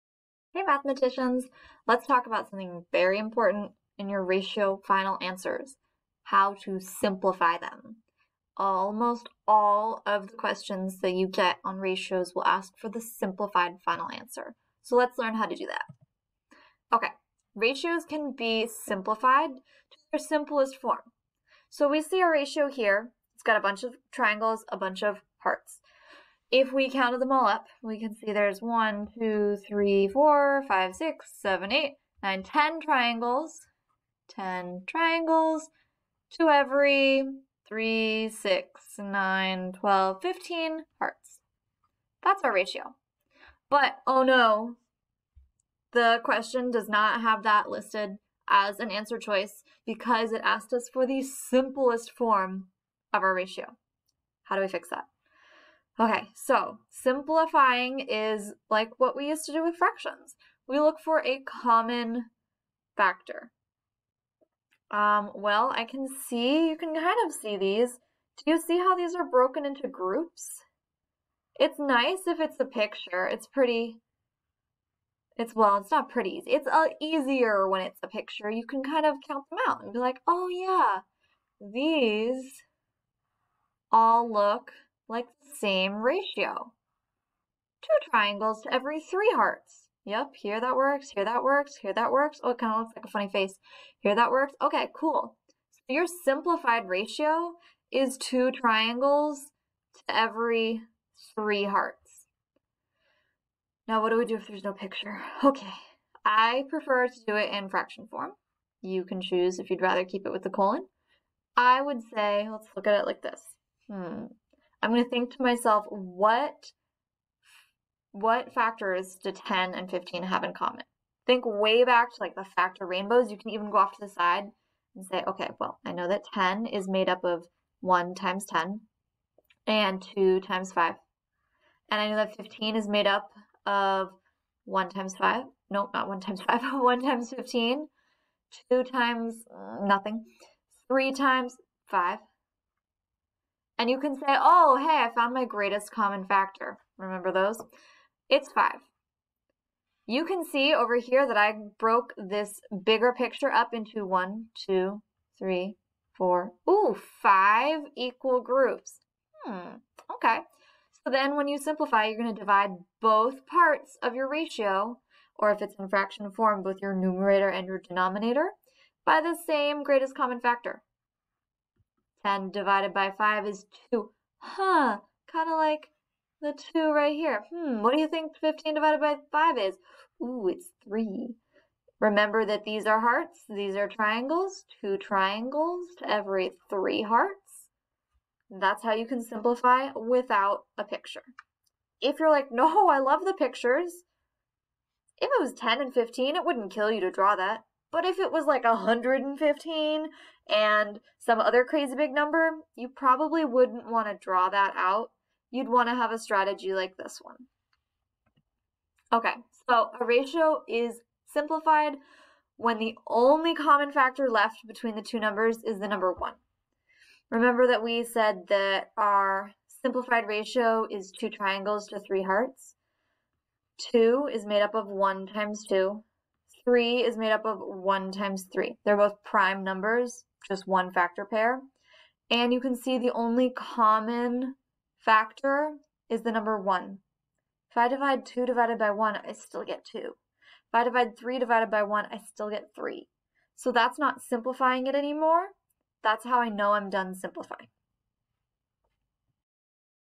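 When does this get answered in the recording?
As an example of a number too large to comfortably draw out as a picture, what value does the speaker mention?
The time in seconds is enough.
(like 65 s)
198 s.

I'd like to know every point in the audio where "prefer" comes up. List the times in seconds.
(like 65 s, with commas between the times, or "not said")
106 s.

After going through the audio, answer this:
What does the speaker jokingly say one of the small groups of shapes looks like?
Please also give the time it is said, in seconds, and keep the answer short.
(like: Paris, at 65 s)
a funny face, at 93 s.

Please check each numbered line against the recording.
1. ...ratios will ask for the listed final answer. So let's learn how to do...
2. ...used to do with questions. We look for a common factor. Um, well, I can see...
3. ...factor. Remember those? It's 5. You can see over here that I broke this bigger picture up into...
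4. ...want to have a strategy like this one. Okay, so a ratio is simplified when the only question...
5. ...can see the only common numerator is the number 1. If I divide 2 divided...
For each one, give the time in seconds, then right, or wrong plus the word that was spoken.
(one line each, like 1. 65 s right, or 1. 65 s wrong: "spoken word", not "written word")
1. 11 s wrong: "simplified", not "listed"
2. 59 s wrong: "fractions", not "questions"
3. 146 s right
4. 205 s wrong: "common", not "question"
5. 232 s wrong: "factor", not "numerator".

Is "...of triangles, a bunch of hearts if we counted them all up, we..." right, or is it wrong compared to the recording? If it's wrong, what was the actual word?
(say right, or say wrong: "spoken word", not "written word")
right.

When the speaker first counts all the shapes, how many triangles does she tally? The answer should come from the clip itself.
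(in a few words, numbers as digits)
10.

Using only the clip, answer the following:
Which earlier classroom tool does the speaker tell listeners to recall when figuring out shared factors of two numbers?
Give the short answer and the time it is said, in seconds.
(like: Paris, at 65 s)
factor rainbows, at 122 s.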